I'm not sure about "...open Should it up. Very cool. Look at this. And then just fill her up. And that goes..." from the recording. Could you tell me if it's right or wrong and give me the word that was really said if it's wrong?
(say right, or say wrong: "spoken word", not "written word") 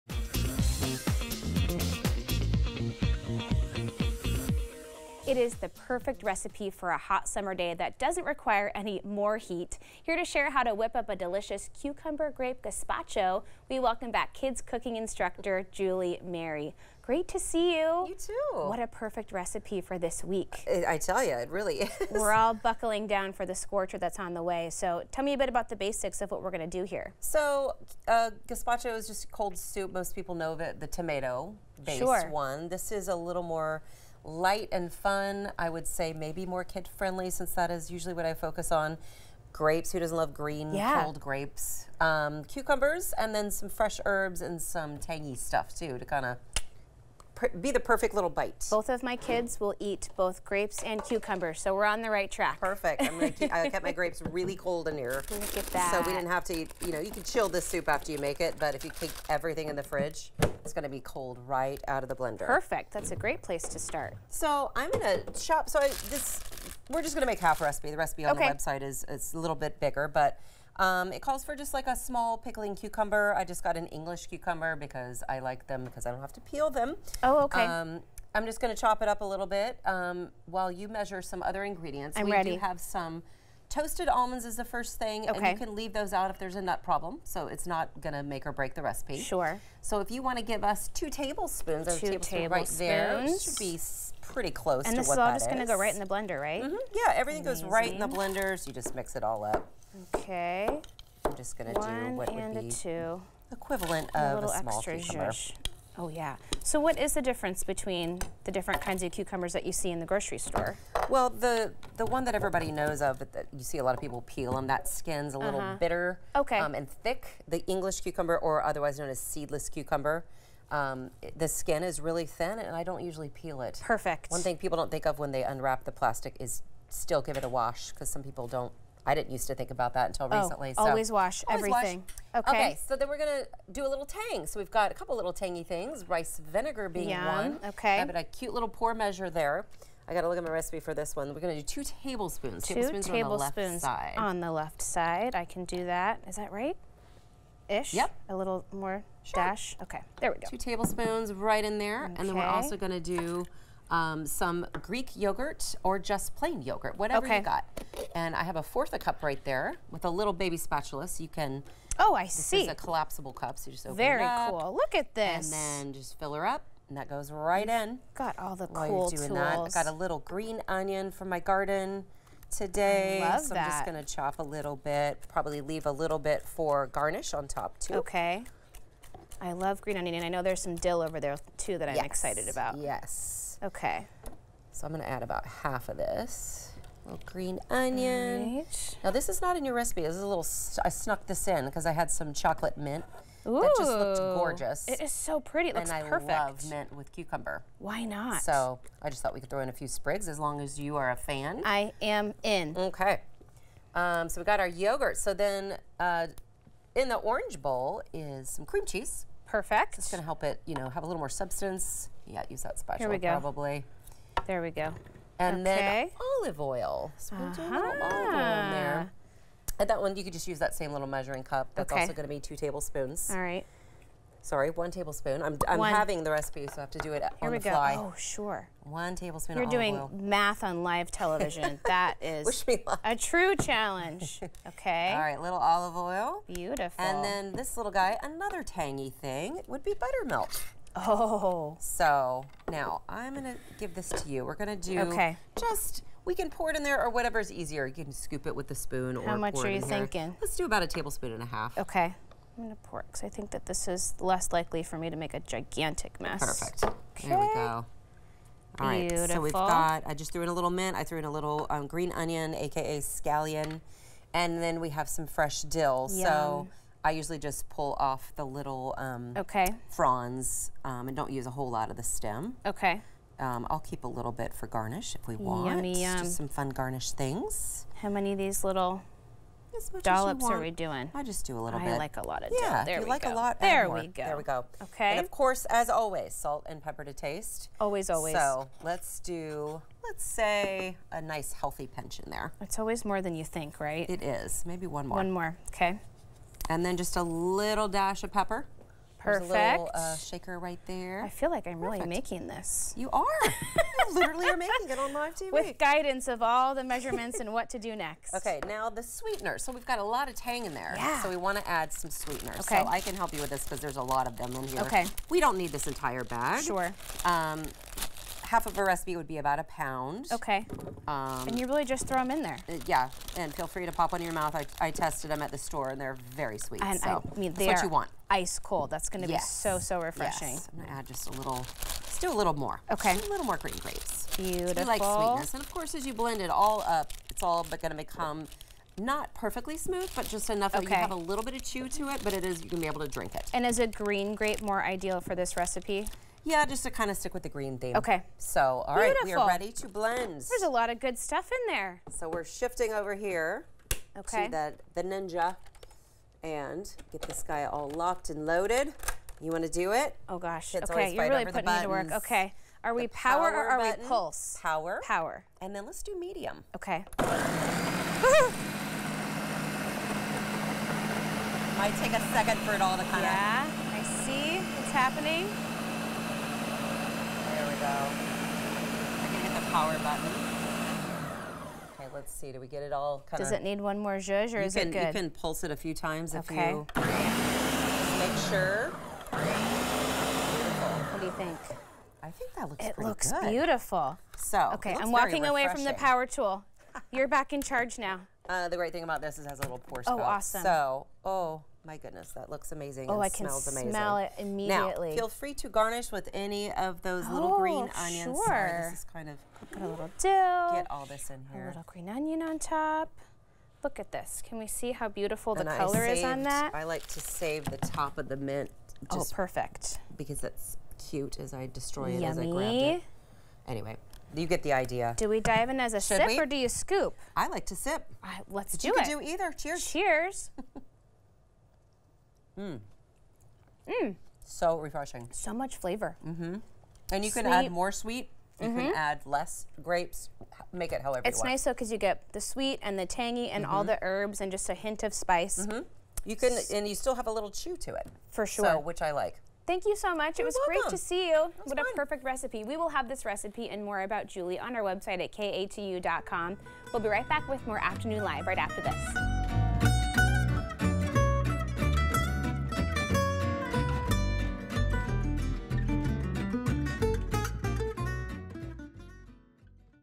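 wrong: "Very", not "Should".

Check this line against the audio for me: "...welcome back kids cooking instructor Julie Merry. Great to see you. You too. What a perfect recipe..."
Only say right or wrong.
right.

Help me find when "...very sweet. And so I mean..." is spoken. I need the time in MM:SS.
05:26.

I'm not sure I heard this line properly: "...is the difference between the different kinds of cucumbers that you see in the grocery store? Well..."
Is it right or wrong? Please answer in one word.
right.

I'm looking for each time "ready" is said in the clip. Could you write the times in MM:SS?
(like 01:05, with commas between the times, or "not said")
01:22, 05:49.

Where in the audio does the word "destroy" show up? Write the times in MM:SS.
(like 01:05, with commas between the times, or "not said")
07:01.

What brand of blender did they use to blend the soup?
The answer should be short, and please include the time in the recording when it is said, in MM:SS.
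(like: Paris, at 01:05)
Ninja, at 05:55.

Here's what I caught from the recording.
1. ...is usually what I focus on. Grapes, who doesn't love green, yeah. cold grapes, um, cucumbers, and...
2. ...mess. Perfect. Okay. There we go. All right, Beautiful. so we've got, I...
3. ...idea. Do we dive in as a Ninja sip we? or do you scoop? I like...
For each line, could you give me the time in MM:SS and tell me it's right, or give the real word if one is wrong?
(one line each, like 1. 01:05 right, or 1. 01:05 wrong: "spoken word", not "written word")
1. 00:37 right
2. 04:16 right
3. 07:04 wrong: "Should", not "Ninja".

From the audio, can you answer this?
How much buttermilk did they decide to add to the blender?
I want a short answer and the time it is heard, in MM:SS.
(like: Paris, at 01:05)
1.5 tablespoons, at 04:10.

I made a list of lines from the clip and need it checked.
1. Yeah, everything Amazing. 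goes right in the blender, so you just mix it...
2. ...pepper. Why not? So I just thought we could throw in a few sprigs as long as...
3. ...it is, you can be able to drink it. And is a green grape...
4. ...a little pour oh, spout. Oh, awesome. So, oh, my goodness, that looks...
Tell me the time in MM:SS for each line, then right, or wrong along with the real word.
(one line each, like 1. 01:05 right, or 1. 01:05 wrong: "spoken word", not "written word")
1. 01:36 right
2. 03:17 wrong: "cucumber", not "pepper"
3. 05:42 right
4. 06:39 right.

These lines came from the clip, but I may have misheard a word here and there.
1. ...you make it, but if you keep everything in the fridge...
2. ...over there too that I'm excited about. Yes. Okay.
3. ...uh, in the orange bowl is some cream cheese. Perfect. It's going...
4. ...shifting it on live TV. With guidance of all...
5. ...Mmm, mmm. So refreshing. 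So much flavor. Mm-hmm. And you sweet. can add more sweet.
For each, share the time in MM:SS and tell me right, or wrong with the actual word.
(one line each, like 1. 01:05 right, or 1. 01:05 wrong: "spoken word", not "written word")
1. 00:58 right
2. 03:01 right
3. 03:25 right
4. 05:04 wrong: "making", not "shifting"
5. 07:12 right.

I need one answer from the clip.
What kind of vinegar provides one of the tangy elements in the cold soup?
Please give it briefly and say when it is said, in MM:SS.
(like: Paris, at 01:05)
Rice vinegar, at 02:16.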